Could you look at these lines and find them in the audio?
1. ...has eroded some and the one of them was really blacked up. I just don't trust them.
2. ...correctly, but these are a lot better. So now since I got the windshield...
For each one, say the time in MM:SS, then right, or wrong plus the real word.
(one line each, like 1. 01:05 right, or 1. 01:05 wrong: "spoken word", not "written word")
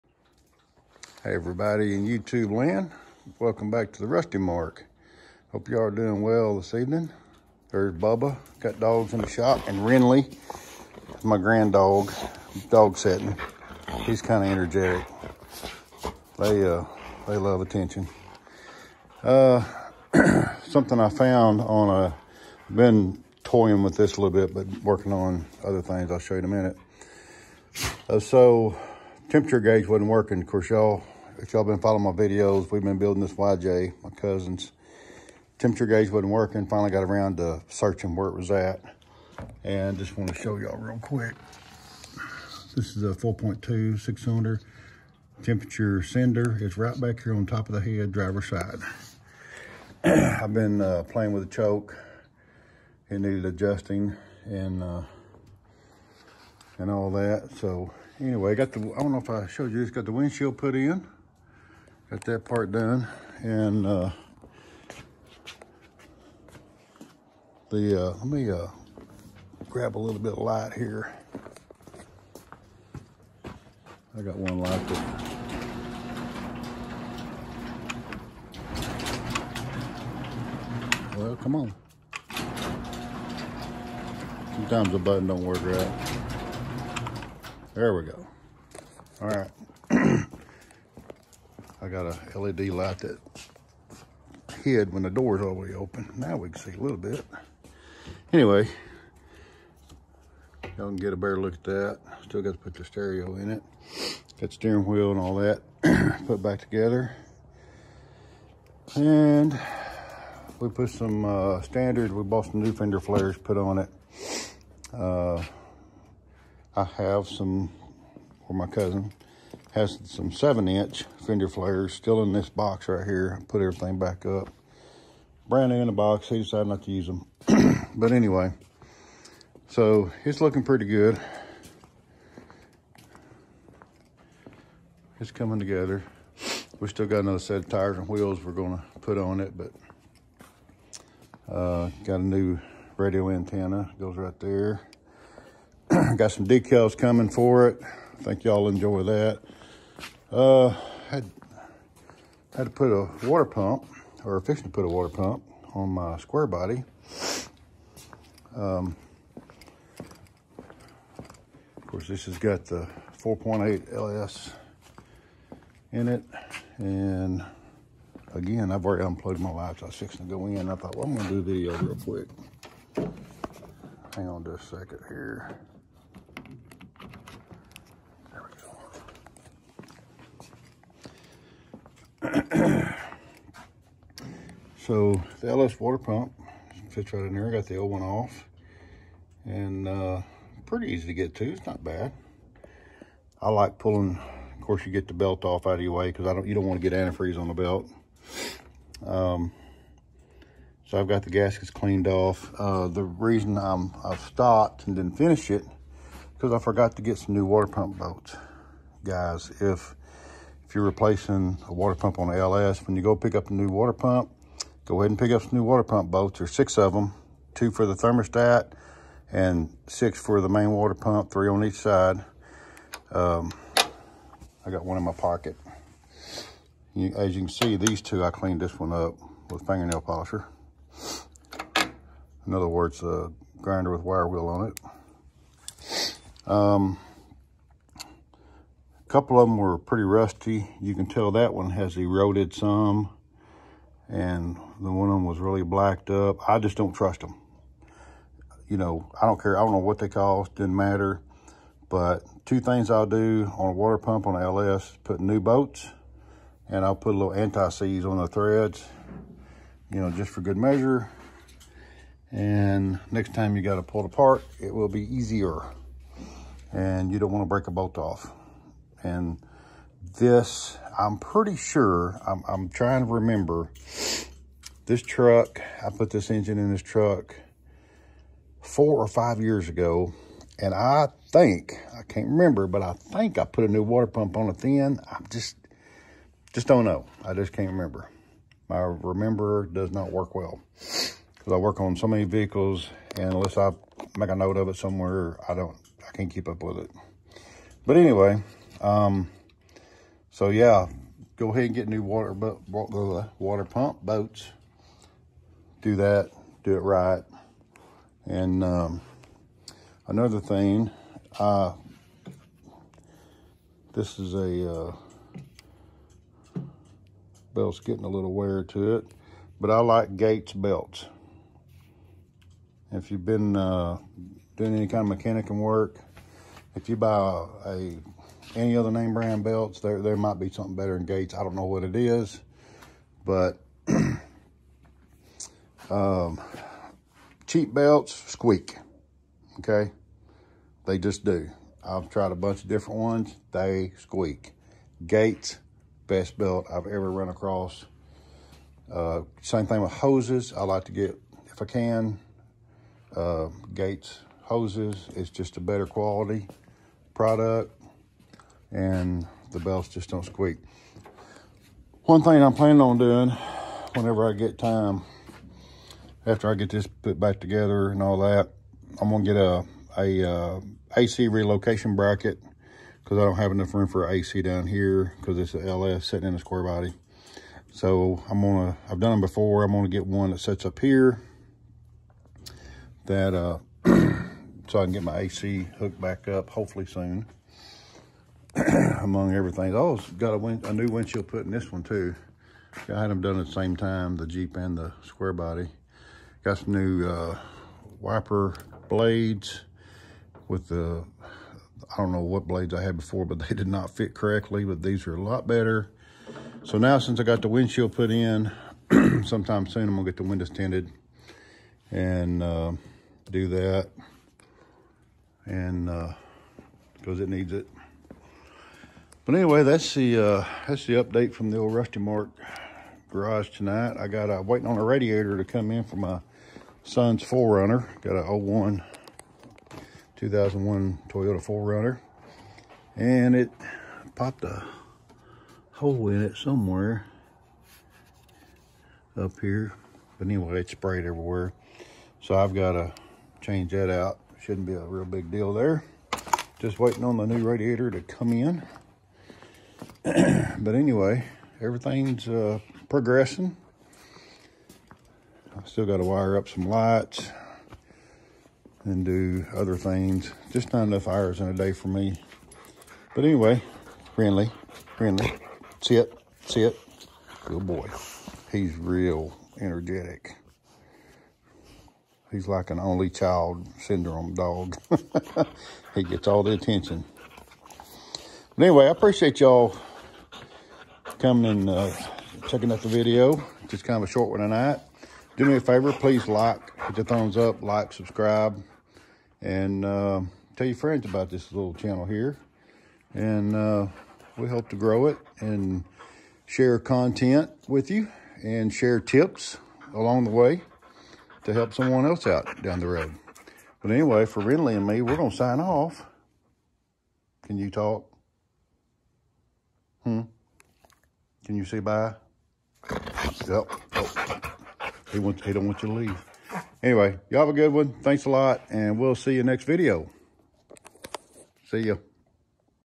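1. 04:01 right
2. 06:44 right.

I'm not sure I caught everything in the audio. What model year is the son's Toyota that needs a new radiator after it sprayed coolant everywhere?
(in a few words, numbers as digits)
2001.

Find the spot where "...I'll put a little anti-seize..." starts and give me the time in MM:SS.
04:16.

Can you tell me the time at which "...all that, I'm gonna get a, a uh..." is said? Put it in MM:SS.
06:08.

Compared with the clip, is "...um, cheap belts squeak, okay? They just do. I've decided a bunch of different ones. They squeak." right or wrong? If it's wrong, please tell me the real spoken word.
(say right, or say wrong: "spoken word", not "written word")
wrong: "tried", not "decided".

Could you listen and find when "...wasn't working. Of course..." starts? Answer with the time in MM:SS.
00:29.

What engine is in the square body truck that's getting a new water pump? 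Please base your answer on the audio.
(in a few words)
4.8 LS.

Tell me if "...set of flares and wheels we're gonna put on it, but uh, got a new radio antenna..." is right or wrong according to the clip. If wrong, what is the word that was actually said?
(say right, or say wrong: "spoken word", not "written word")
wrong: "tires", not "flares".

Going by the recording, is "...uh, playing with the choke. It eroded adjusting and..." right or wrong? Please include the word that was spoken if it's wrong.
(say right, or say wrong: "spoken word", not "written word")
wrong: "needed", not "eroded".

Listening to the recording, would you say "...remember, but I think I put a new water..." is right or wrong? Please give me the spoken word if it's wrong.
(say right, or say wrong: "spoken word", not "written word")
right.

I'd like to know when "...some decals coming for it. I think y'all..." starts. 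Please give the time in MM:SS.
02:26.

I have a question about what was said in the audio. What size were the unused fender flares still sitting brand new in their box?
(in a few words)
7 inch.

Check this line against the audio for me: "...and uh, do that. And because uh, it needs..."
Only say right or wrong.
right.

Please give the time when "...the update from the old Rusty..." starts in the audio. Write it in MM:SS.
07:00.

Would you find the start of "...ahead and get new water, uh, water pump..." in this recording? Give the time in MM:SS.
05:01.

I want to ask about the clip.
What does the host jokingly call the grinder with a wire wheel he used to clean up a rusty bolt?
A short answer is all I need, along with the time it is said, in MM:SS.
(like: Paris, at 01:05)
fingernail polisher, at 03:49.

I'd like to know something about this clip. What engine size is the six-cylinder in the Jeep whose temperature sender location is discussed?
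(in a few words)
4.2.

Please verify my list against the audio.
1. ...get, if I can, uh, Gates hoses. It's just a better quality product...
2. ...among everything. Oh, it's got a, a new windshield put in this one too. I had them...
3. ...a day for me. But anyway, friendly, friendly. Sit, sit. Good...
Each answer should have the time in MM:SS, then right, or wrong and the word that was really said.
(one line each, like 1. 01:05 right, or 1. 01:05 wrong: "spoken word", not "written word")
1. 05:50 right
2. 06:29 right
3. 07:41 right.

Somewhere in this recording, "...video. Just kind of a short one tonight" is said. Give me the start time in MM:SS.
08:02.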